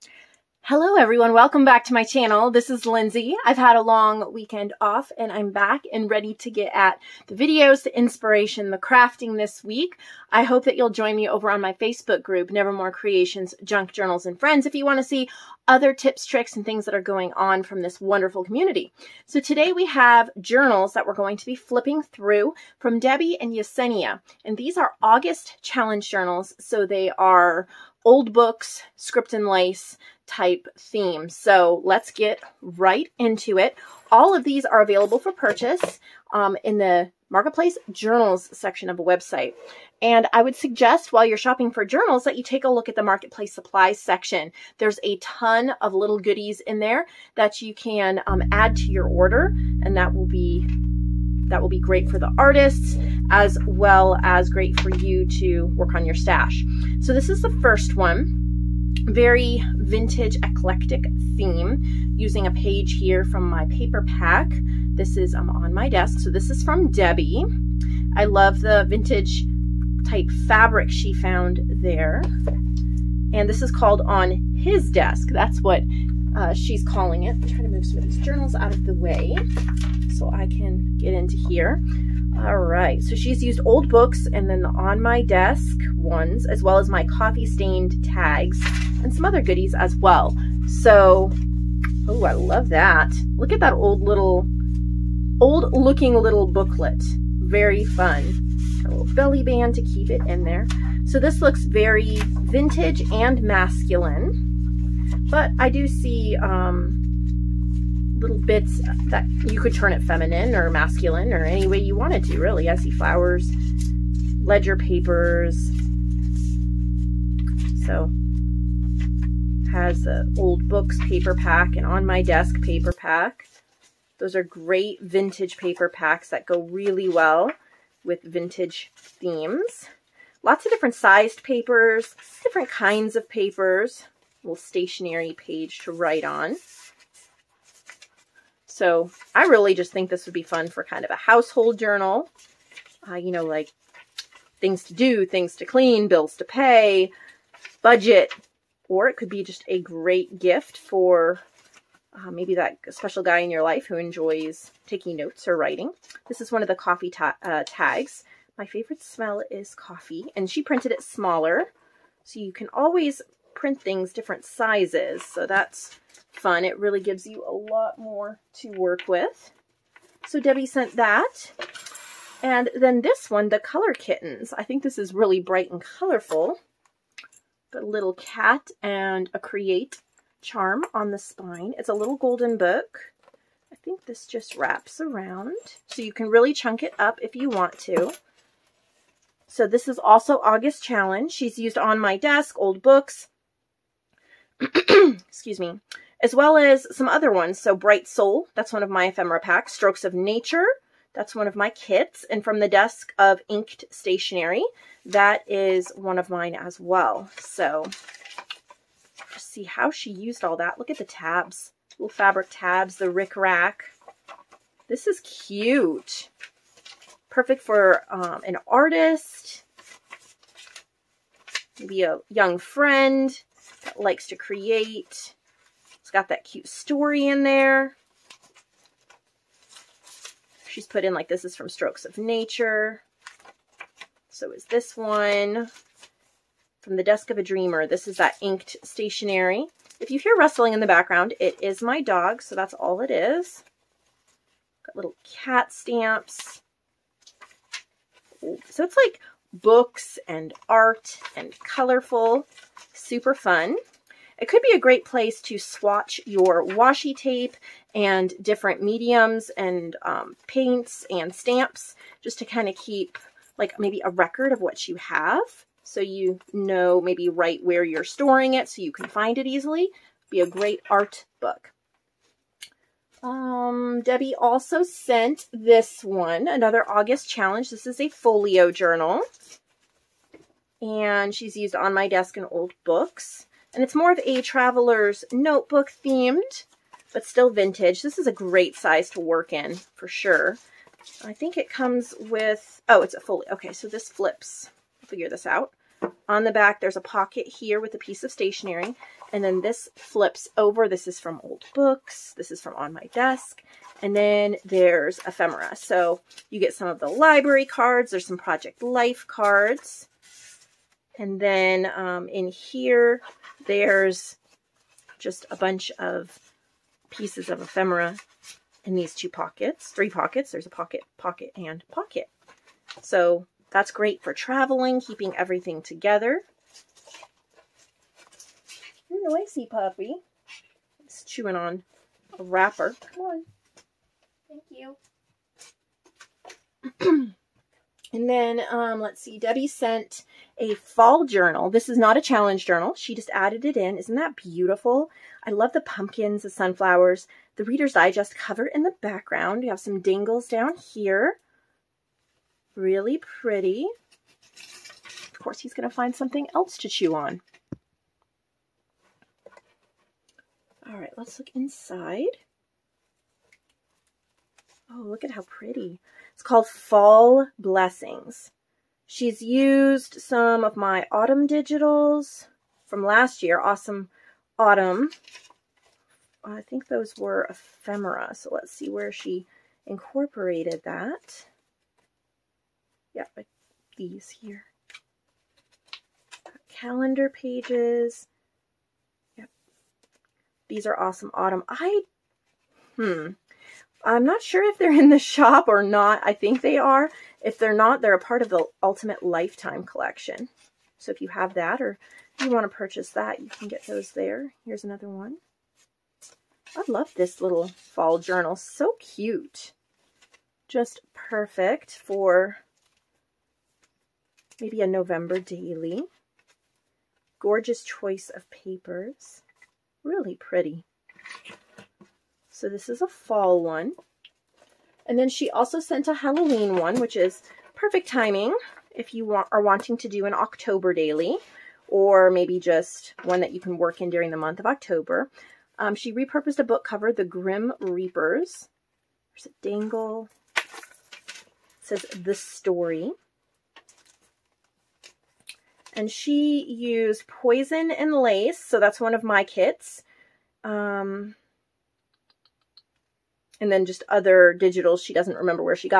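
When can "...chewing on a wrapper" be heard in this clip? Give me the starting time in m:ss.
5:31.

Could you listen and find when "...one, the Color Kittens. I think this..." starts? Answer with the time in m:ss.
2:53.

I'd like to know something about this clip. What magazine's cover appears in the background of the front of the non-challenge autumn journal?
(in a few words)
Reader's Digest.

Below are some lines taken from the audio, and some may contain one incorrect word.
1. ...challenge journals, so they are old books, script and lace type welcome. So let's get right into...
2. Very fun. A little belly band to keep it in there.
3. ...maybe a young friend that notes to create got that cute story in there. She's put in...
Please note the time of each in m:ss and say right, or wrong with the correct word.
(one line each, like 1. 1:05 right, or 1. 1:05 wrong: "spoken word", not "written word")
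1. 0:25 wrong: "theme", not "welcome"
2. 1:37 right
3. 3:41 wrong: "likes", not "notes".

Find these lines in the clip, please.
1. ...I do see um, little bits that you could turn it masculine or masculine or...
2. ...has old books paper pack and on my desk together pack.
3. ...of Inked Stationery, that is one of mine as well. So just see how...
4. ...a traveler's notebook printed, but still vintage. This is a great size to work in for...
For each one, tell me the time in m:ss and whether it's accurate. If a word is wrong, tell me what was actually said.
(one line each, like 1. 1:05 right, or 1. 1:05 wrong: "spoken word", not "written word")
1. 1:45 wrong: "feminine", not "masculine"
2. 1:59 wrong: "paper", not "together"
3. 3:23 right
4. 4:44 wrong: "themed", not "printed".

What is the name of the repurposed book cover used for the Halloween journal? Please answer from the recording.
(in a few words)
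The Grim Reapers.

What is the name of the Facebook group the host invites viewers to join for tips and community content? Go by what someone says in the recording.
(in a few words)
Nevermore Creations, Junk Journals and Friends.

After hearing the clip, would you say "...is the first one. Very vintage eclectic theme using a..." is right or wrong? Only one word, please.
right.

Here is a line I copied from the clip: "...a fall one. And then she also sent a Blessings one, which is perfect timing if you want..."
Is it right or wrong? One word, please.
wrong.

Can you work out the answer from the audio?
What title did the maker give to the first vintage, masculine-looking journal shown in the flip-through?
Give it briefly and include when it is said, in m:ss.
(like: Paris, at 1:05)
On His Desk, at 1:14.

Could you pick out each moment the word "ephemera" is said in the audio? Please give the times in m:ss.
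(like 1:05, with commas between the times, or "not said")
3:19, 5:05, 5:17, 6:17.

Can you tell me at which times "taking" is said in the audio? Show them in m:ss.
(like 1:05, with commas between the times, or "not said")
2:34.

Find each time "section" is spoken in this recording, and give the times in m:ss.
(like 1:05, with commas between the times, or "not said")
0:38, 0:43.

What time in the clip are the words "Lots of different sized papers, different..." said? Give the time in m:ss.
2:10.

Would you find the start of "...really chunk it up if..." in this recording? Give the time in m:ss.
3:06.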